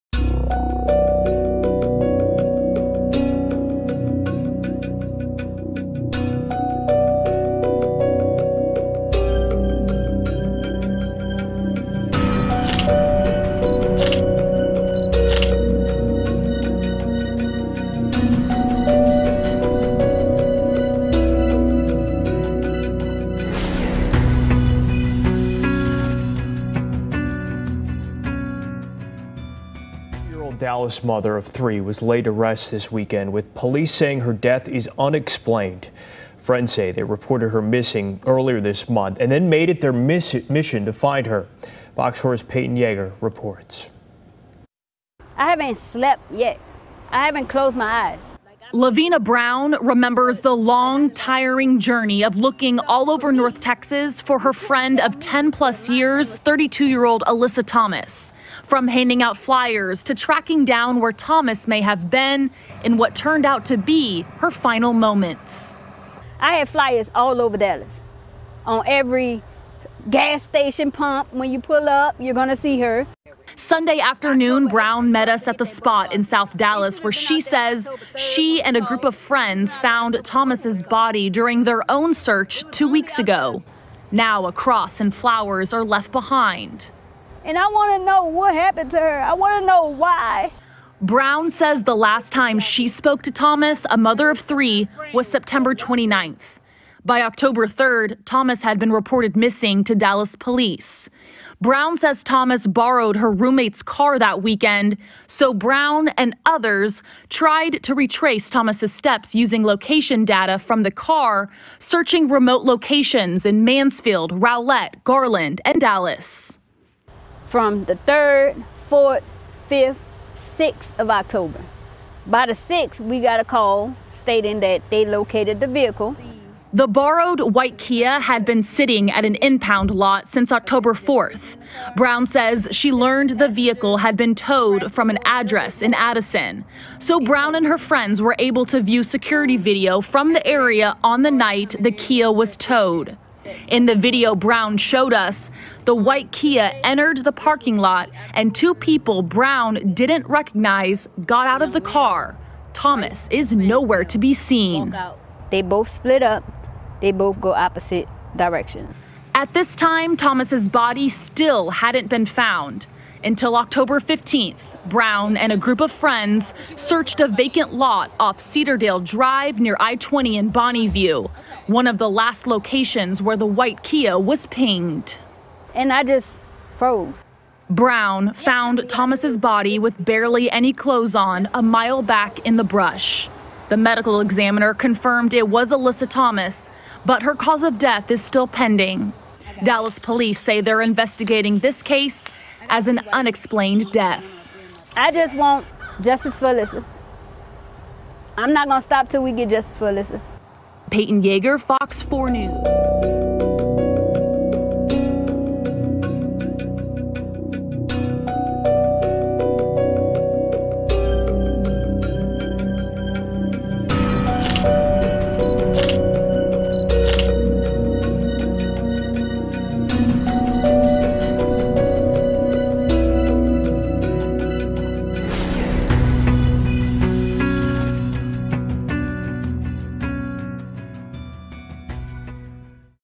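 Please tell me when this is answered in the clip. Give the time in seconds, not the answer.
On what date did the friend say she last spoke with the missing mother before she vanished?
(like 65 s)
95 s.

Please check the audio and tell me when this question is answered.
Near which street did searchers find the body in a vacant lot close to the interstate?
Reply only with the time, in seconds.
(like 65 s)
168 s.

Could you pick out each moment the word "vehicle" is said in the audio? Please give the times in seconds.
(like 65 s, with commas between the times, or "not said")
125 s, 133 s.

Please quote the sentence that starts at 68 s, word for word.
On every gas station pump, when you pull up, you're going to see her.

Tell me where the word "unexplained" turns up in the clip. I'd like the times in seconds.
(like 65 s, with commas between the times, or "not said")
34 s, 193 s.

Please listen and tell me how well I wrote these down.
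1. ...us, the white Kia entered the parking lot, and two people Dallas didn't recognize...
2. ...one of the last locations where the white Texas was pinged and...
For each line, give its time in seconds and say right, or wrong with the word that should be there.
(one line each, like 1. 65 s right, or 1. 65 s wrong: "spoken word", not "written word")
1. 145 s wrong: "Brown", not "Dallas"
2. 171 s wrong: "Kia", not "Texas".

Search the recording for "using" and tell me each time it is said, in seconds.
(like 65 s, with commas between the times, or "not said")
109 s.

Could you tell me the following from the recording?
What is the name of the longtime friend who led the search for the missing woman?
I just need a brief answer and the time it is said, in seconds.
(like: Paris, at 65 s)
Lavina Brown, at 48 s.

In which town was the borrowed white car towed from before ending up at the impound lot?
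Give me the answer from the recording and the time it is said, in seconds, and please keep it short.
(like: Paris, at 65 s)
Addison, at 135 s.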